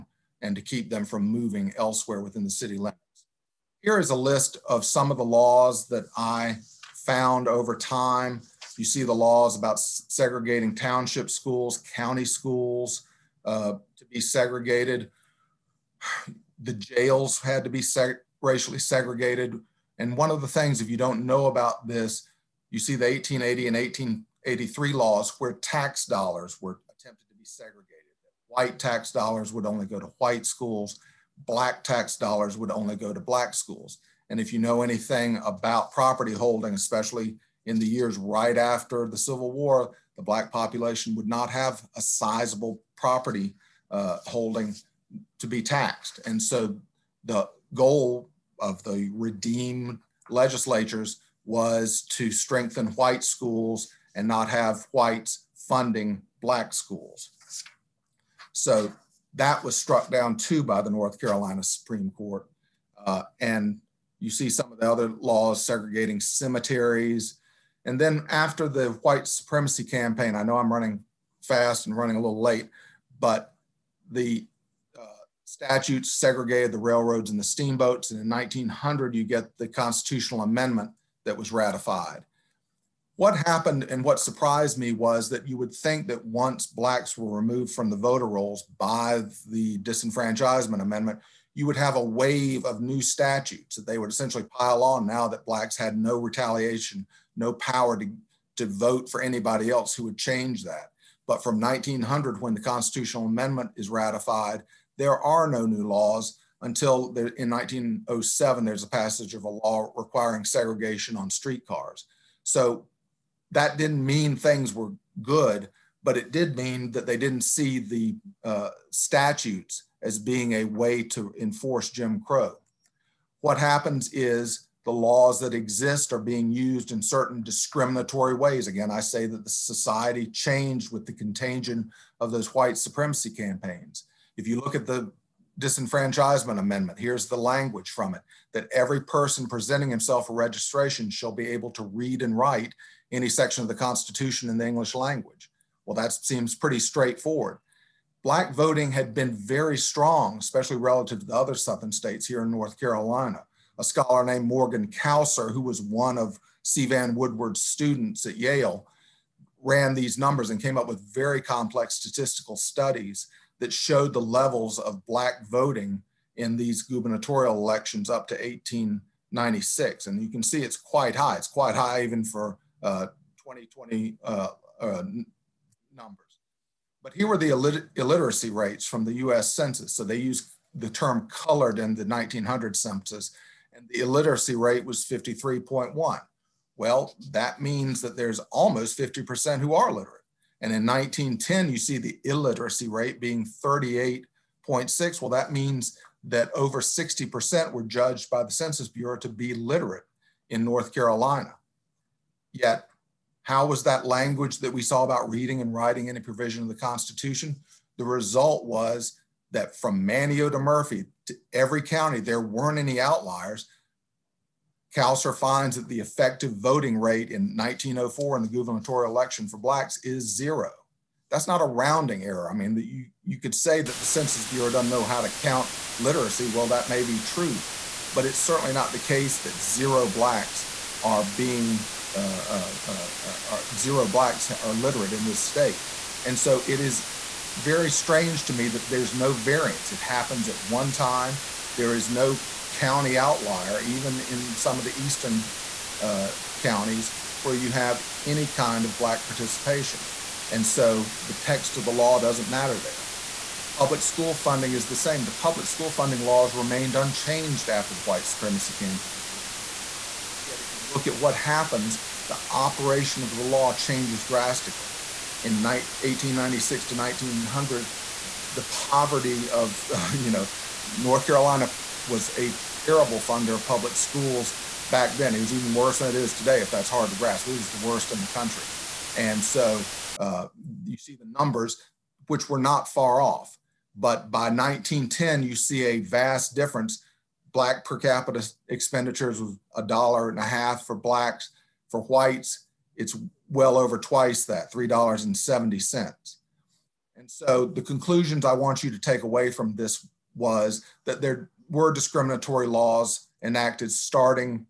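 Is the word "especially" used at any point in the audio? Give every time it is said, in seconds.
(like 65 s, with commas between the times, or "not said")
36 s, 150 s.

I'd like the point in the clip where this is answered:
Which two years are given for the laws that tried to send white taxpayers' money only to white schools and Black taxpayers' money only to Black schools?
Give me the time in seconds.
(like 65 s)
23 s.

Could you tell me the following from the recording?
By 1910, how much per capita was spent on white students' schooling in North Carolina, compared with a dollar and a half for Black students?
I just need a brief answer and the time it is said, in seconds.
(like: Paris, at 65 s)
$3.70, at 294 s.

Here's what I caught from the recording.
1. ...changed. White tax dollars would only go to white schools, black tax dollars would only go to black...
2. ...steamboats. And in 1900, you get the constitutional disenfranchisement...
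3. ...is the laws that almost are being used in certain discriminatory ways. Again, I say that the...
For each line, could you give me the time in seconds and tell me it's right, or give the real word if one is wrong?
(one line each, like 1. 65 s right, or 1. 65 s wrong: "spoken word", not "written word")
1. 27 s wrong: "segregated", not "changed"
2. 77 s wrong: "amendment", not "disenfranchisement"
3. 124 s wrong: "exist", not "almost".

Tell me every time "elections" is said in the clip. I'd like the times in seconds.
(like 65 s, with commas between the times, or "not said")
167 s, 219 s.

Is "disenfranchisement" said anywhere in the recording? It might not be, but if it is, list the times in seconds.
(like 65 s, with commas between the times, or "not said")
89 s, 135 s.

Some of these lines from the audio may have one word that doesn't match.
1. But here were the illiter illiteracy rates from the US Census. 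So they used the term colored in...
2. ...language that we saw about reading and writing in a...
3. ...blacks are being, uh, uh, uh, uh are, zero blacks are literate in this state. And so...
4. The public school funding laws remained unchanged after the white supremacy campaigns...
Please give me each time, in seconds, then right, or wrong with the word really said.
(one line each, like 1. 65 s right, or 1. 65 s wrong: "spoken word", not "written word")
1. 177 s right
2. 204 s right
3. 230 s right
4. 255 s right.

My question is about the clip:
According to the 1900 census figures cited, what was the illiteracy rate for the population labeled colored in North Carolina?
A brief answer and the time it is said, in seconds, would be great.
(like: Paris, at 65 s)
53.1, at 185 s.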